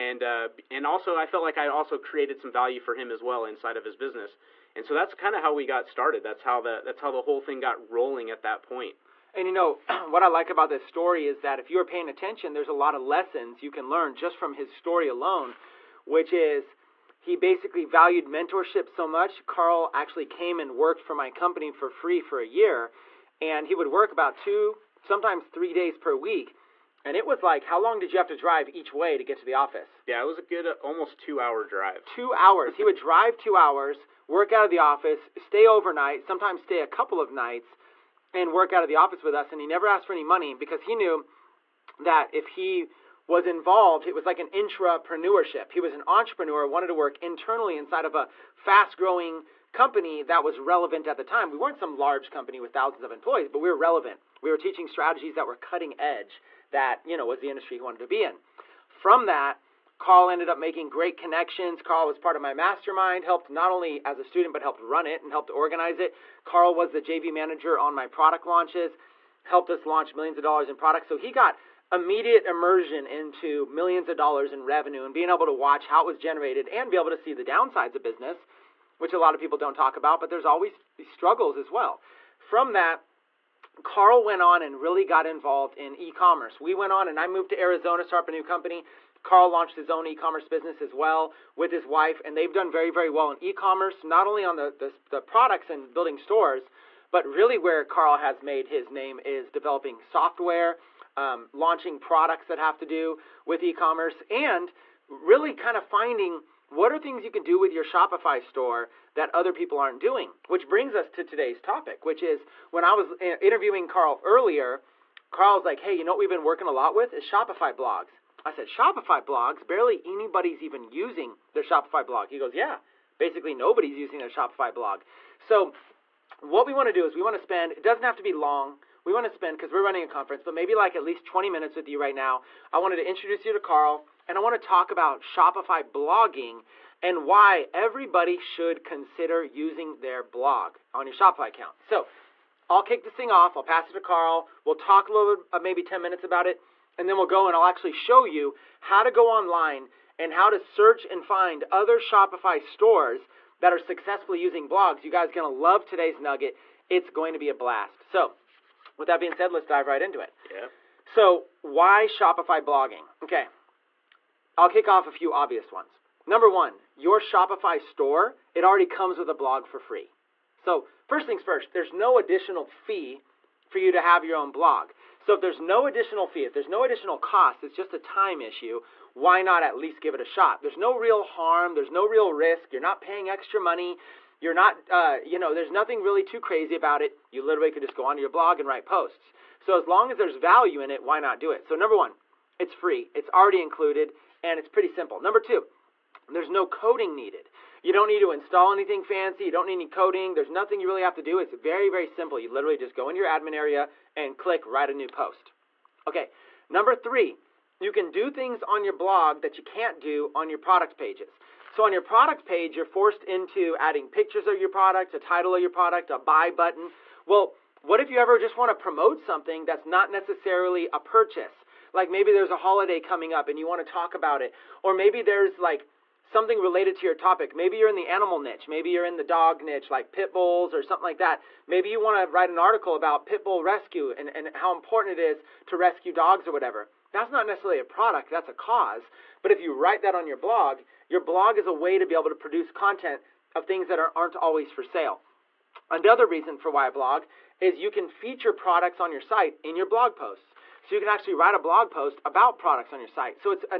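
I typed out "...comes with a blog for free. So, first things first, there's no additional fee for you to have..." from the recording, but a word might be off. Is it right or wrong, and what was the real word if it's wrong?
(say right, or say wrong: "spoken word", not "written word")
right.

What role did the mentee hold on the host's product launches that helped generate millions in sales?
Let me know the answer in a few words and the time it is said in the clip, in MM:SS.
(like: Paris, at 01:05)
JV manager, at 01:07.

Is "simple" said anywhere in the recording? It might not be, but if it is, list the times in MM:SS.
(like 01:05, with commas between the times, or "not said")
03:14, 03:22.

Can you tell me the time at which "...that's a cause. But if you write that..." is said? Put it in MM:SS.
03:58.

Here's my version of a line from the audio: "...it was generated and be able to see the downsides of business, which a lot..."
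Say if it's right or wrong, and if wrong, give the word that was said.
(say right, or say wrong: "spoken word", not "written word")
right.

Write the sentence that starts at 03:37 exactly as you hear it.
Well, what if you ever just want to promote something that's not necessarily a purchase?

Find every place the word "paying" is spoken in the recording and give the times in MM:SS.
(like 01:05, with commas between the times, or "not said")
00:11, 03:03.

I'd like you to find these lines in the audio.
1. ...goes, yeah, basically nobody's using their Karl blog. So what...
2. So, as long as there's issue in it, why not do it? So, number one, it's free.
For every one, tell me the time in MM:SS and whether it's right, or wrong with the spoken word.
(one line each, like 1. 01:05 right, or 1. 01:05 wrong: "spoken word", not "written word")
1. 02:02 wrong: "Shopify", not "Karl"
2. 03:09 wrong: "value", not "issue".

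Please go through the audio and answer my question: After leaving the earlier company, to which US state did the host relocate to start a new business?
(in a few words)
Arizona.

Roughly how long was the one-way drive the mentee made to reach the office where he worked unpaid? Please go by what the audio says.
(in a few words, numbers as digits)
2 hours.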